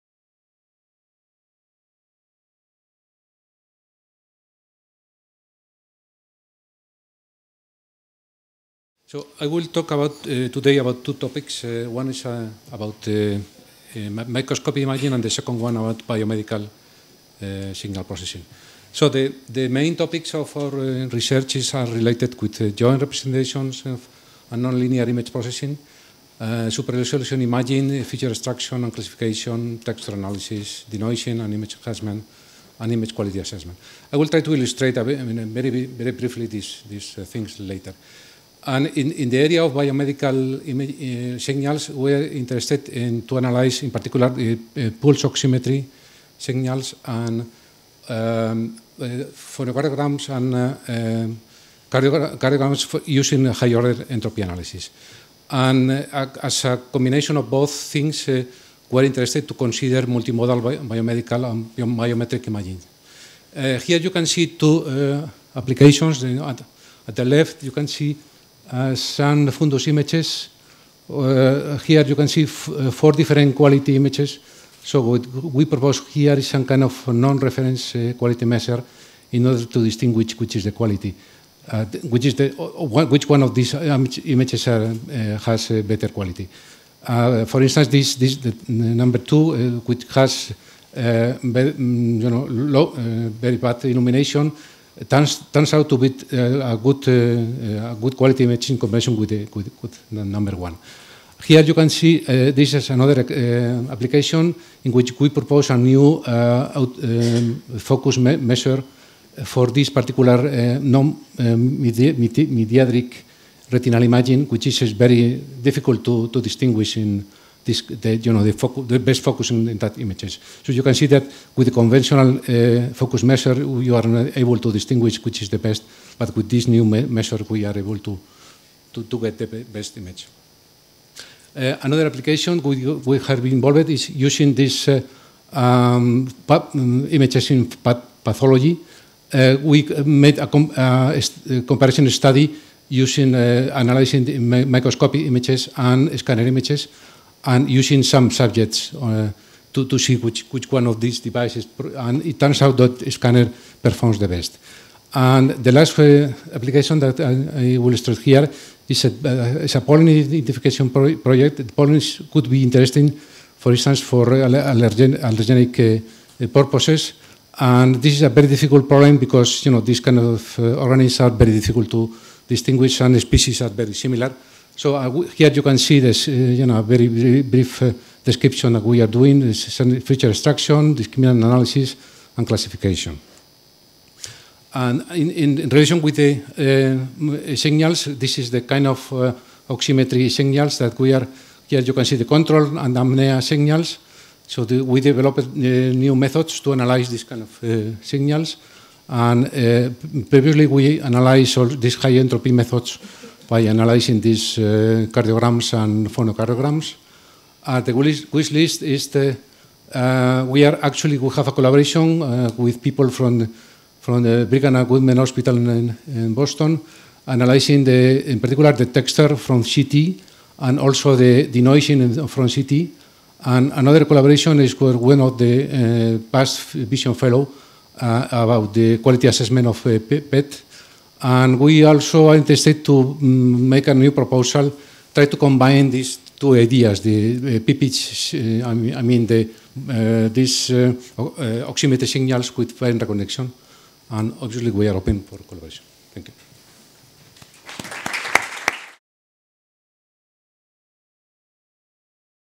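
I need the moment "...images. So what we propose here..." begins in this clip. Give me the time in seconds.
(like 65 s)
73 s.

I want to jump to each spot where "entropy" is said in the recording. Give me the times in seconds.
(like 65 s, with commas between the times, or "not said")
54 s, 202 s.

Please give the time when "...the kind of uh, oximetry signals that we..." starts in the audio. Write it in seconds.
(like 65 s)
188 s.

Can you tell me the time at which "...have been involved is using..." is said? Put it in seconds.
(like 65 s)
133 s.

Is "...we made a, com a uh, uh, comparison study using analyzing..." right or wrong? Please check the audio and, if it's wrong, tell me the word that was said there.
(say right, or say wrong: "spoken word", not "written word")
right.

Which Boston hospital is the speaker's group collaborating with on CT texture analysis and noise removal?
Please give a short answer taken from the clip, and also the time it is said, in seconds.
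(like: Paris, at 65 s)
Brigham and Women's Hospital, at 214 s.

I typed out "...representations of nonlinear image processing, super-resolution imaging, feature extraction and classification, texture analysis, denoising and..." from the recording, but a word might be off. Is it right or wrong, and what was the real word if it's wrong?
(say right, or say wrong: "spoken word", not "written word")
right.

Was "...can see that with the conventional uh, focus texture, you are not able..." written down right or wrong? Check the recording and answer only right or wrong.
wrong.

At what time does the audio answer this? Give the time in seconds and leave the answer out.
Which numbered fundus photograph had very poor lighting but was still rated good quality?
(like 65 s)
88 s.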